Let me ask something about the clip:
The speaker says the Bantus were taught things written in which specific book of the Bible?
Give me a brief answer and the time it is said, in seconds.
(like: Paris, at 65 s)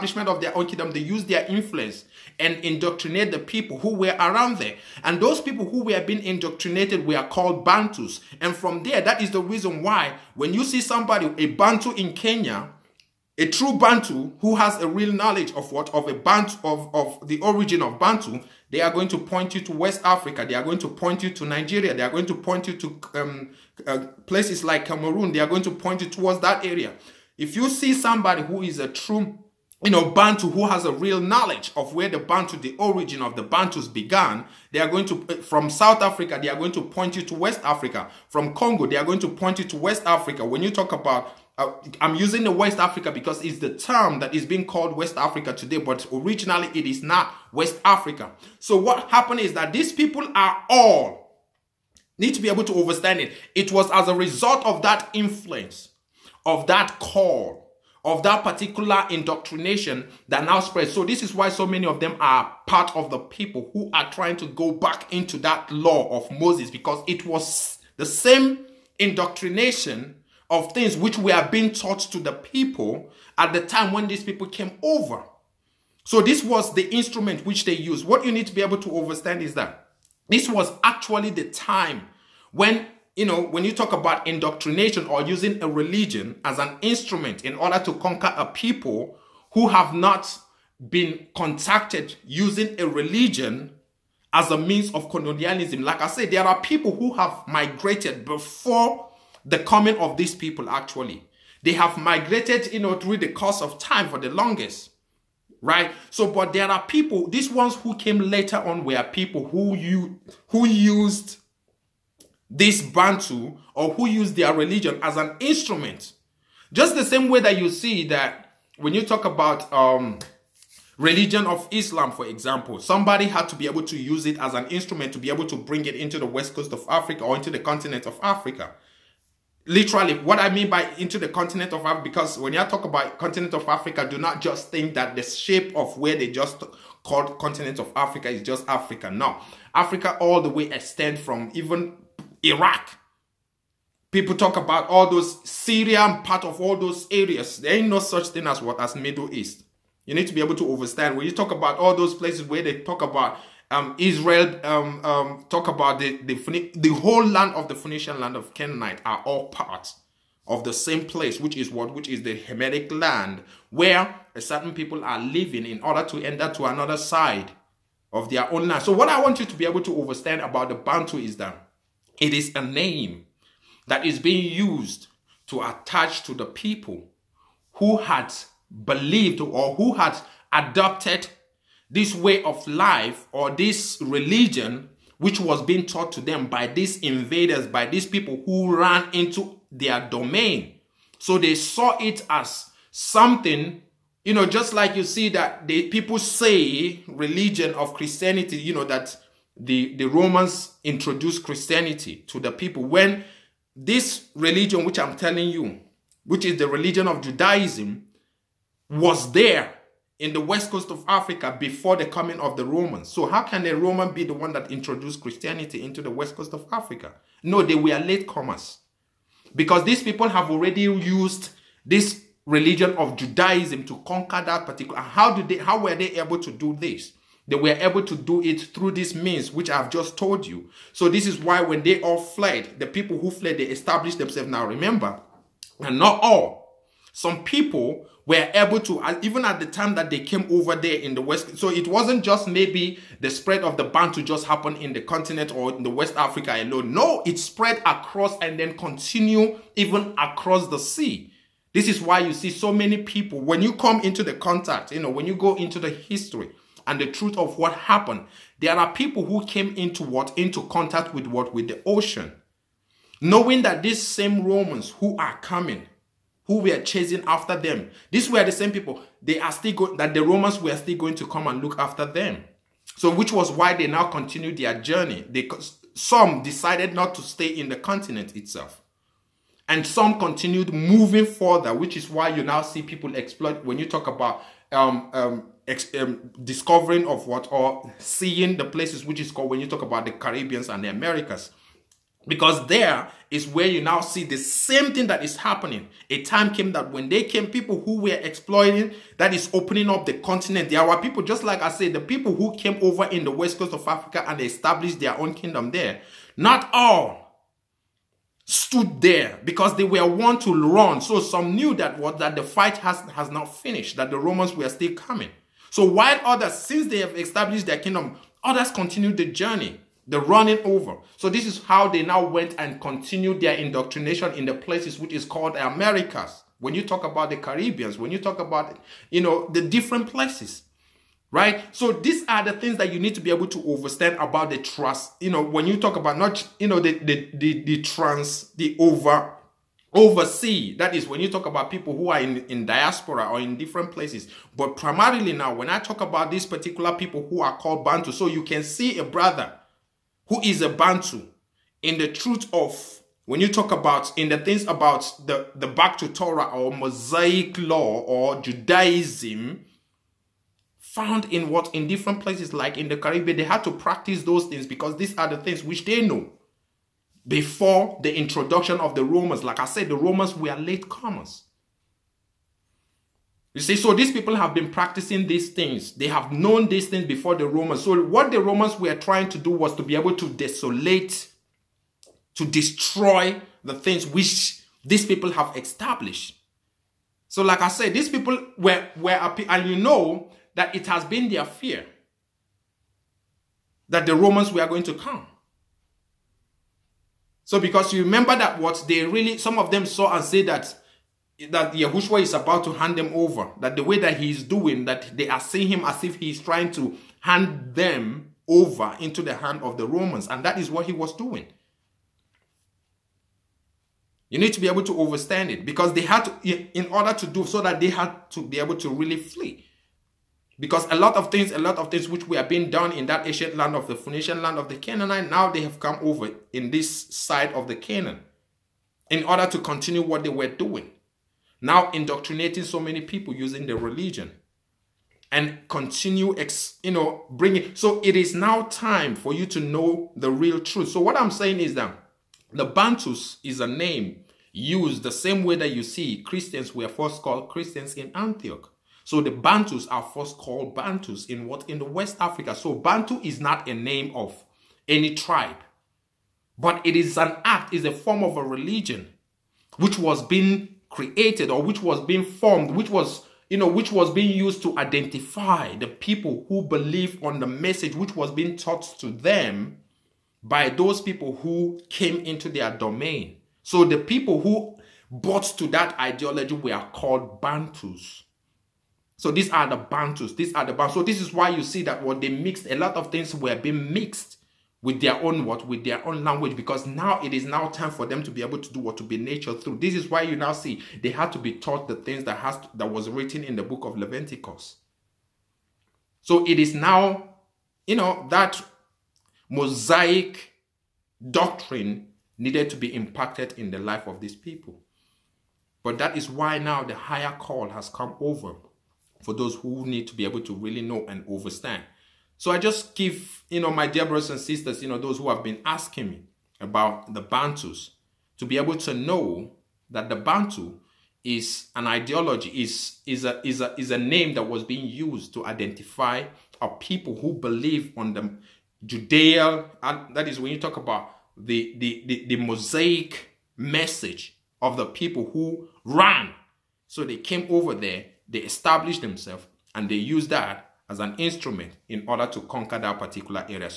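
Leviticus, at 493 s.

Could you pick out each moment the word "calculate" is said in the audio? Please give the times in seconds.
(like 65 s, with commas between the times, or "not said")
not said.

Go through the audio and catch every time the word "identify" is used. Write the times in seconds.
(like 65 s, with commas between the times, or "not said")
464 s, 525 s.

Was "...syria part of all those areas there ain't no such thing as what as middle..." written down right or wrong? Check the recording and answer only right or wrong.
right.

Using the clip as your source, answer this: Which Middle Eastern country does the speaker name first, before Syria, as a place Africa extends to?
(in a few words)
Iraq.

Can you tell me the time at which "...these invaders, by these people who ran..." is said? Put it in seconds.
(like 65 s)
186 s.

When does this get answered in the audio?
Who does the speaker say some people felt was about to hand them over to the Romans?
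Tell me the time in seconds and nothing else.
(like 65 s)
401 s.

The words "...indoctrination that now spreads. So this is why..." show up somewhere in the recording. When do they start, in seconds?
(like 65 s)
59 s.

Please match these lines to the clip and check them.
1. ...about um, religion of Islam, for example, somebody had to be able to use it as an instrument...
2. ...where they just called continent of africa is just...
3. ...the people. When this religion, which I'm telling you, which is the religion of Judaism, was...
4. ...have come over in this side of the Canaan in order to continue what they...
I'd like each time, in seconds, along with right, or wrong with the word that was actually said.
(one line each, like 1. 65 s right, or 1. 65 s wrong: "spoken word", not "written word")
1. 119 s right
2. 135 s right
3. 202 s right
4. 425 s right.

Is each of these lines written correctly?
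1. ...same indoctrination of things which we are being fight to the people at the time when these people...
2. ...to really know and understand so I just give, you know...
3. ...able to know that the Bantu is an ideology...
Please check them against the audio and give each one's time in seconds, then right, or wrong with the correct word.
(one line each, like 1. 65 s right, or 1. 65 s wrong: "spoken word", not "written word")
1. 68 s wrong: "taught", not "fight"
2. 510 s right
3. 518 s right.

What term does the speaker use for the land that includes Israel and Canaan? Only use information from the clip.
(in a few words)
Hamitic land.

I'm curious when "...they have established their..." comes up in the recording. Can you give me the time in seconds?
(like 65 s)
316 s.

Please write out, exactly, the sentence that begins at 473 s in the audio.
So the people who bought to that ideology were called Bantus.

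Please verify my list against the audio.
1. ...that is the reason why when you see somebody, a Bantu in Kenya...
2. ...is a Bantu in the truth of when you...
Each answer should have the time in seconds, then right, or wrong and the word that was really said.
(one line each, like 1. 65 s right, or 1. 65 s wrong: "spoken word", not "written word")
1. 8 s right
2. 350 s right.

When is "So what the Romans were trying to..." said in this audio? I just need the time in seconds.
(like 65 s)
377 s.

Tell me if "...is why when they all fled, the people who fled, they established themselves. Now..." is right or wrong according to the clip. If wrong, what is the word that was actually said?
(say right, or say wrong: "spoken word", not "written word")
right.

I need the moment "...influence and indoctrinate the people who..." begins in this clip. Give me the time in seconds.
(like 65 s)
1 s.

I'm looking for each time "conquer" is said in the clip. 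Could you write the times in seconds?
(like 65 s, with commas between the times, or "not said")
87 s, 224 s, 542 s.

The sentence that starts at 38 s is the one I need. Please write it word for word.
From Congo, they are going to point you to West Africa.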